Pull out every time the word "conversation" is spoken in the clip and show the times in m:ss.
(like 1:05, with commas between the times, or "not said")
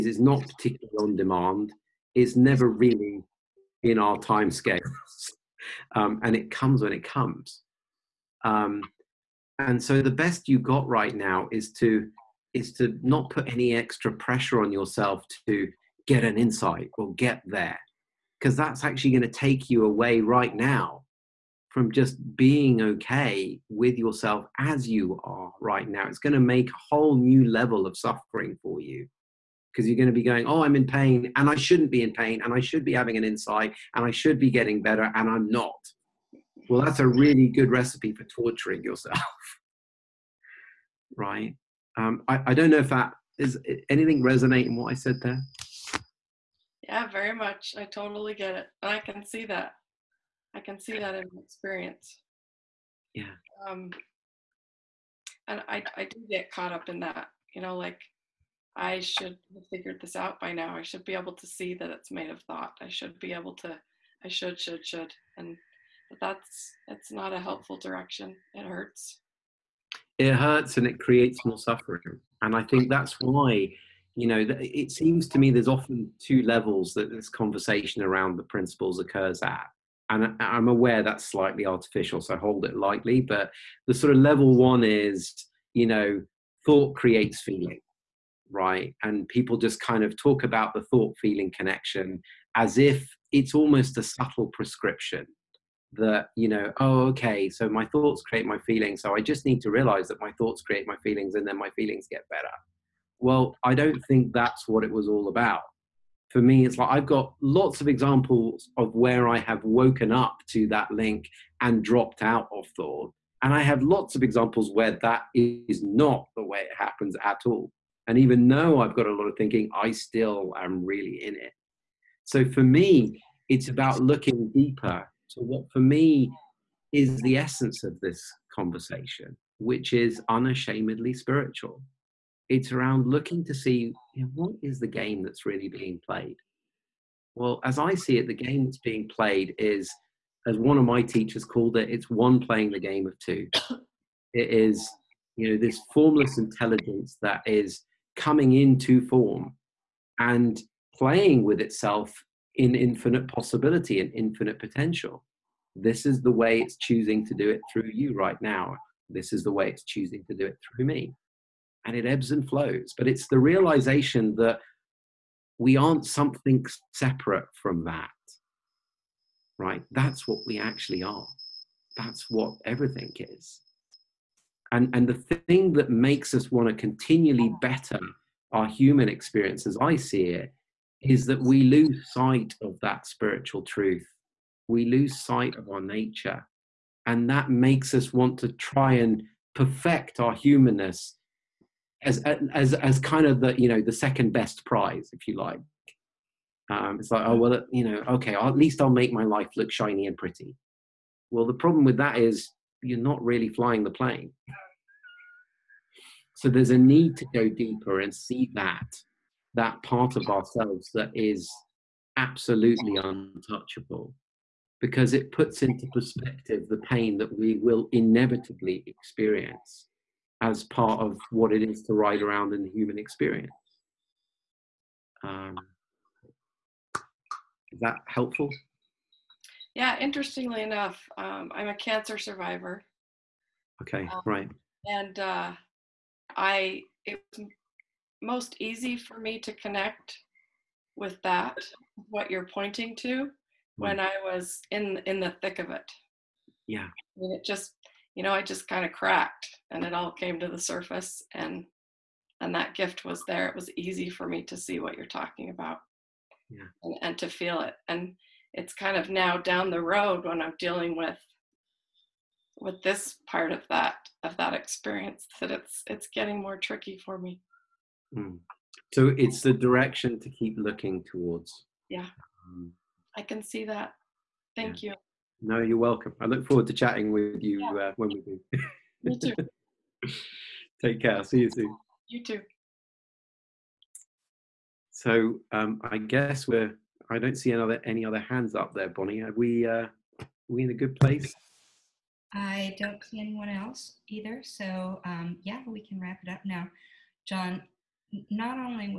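1:17, 2:08.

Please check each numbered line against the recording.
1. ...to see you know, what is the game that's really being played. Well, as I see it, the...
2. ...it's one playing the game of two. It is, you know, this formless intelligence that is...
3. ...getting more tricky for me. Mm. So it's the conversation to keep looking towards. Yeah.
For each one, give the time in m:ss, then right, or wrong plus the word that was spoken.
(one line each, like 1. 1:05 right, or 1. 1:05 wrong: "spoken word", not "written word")
1. 2:13 right
2. 2:21 right
3. 4:26 wrong: "direction", not "conversation".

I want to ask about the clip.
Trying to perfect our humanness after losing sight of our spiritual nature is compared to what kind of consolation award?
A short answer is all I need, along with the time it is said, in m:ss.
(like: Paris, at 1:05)
second best prize, at 3:13.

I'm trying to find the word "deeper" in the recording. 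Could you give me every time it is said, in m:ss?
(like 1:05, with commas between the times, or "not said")
2:04, 3:27.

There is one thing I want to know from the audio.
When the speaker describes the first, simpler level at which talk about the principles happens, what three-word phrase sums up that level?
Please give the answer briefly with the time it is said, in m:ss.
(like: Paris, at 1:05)
thought creates feeling, at 1:26.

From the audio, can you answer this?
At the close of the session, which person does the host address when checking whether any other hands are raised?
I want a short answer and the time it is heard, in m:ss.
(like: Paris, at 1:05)
Bonnie, at 4:48.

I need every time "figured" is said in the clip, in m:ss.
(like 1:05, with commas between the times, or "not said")
0:59.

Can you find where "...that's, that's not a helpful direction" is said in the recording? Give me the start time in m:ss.
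1:06.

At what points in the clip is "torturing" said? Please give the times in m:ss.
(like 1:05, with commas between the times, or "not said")
0:38.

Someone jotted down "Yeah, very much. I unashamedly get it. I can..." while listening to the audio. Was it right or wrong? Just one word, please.
wrong.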